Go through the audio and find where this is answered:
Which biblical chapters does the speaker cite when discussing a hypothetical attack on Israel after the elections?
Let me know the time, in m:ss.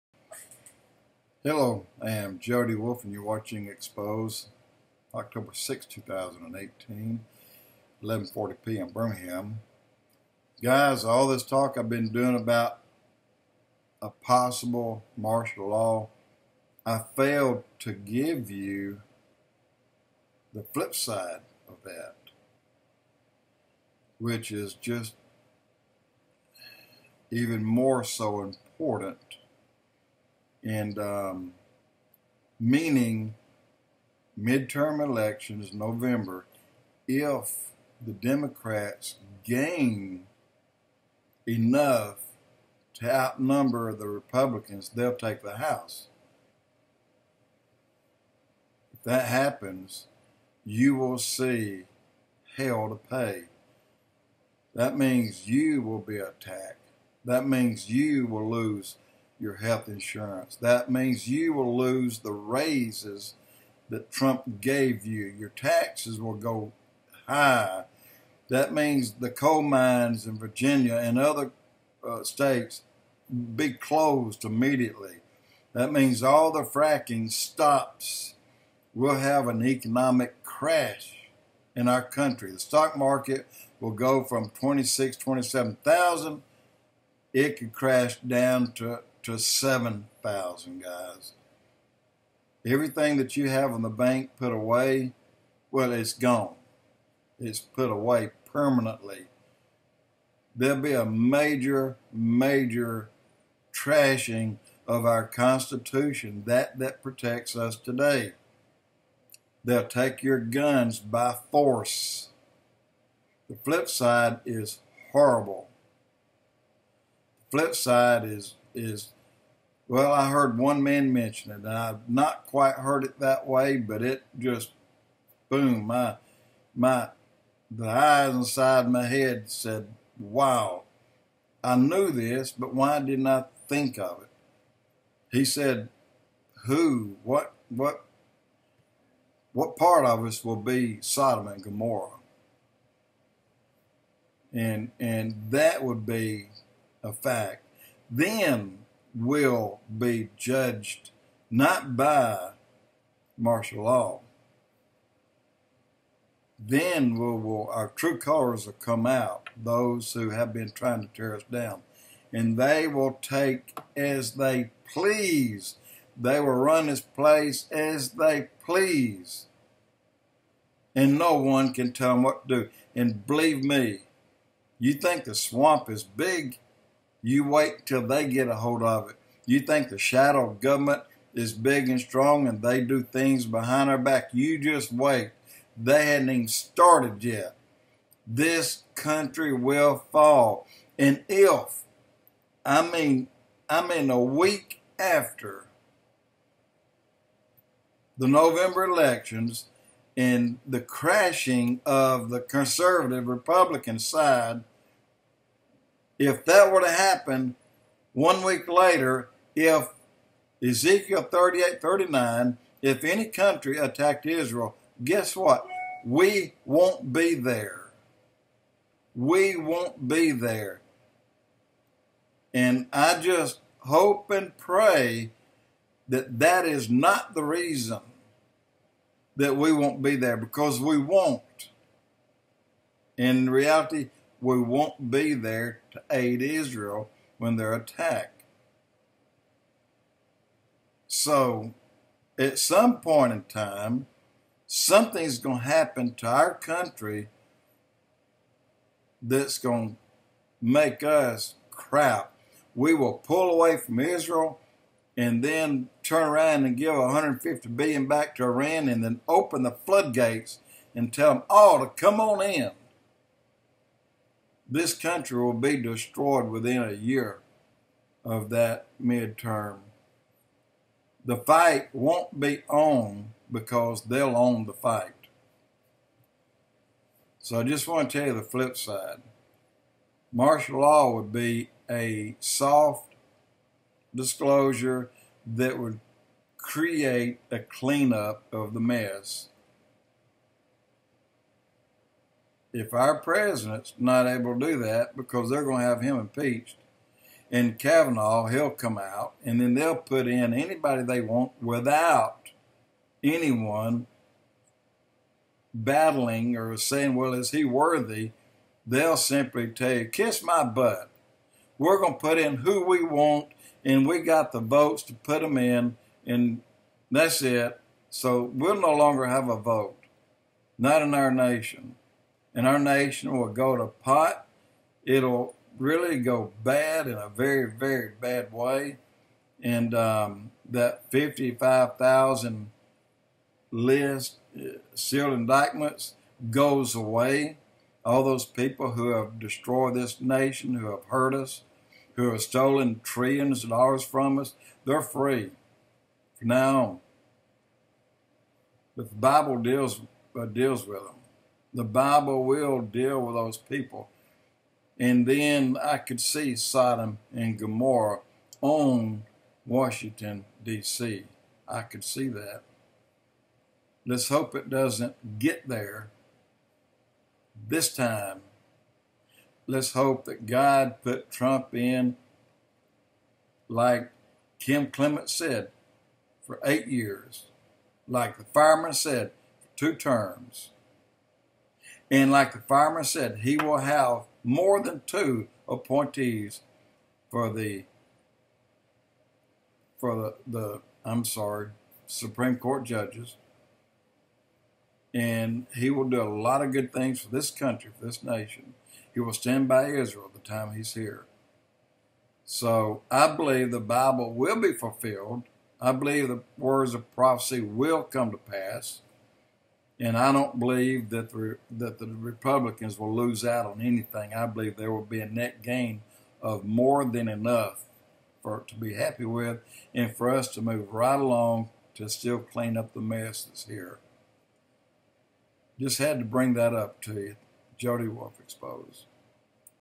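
3:30.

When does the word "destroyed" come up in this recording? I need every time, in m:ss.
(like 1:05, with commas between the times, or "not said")
4:25, 5:39.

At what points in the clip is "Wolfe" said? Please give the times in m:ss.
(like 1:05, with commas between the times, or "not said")
0:02, 7:08.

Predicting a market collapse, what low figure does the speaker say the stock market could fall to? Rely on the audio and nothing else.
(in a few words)
7,000.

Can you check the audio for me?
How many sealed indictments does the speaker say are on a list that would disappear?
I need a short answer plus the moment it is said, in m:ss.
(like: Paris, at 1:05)
55,000, at 5:31.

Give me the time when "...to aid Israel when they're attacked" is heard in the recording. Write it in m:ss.
3:55.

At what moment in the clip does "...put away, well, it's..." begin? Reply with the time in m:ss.
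1:34.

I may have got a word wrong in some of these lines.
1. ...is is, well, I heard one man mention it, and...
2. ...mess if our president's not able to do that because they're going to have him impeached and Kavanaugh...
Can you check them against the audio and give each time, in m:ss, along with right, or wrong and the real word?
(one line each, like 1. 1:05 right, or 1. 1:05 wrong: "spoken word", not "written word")
1. 1:58 right
2. 4:48 right.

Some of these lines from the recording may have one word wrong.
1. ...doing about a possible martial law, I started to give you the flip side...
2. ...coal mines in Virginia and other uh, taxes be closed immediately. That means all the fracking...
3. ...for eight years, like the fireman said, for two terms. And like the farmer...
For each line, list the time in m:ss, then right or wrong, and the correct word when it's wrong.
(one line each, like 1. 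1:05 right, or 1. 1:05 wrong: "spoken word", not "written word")
1. 0:12 wrong: "failed", not "started"
2. 1:09 wrong: "states", not "taxes"
3. 6:16 right.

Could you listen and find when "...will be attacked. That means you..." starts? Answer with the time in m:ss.
0:55.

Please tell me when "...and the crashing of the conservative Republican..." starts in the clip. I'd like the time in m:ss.
3:20.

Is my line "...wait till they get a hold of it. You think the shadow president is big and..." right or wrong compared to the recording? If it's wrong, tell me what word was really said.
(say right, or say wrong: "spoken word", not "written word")
wrong: "government", not "president".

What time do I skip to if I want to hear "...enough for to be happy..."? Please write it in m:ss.
6:57.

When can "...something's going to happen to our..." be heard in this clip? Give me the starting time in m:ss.
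4:04.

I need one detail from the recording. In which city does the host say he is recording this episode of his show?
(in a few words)
Birmingham.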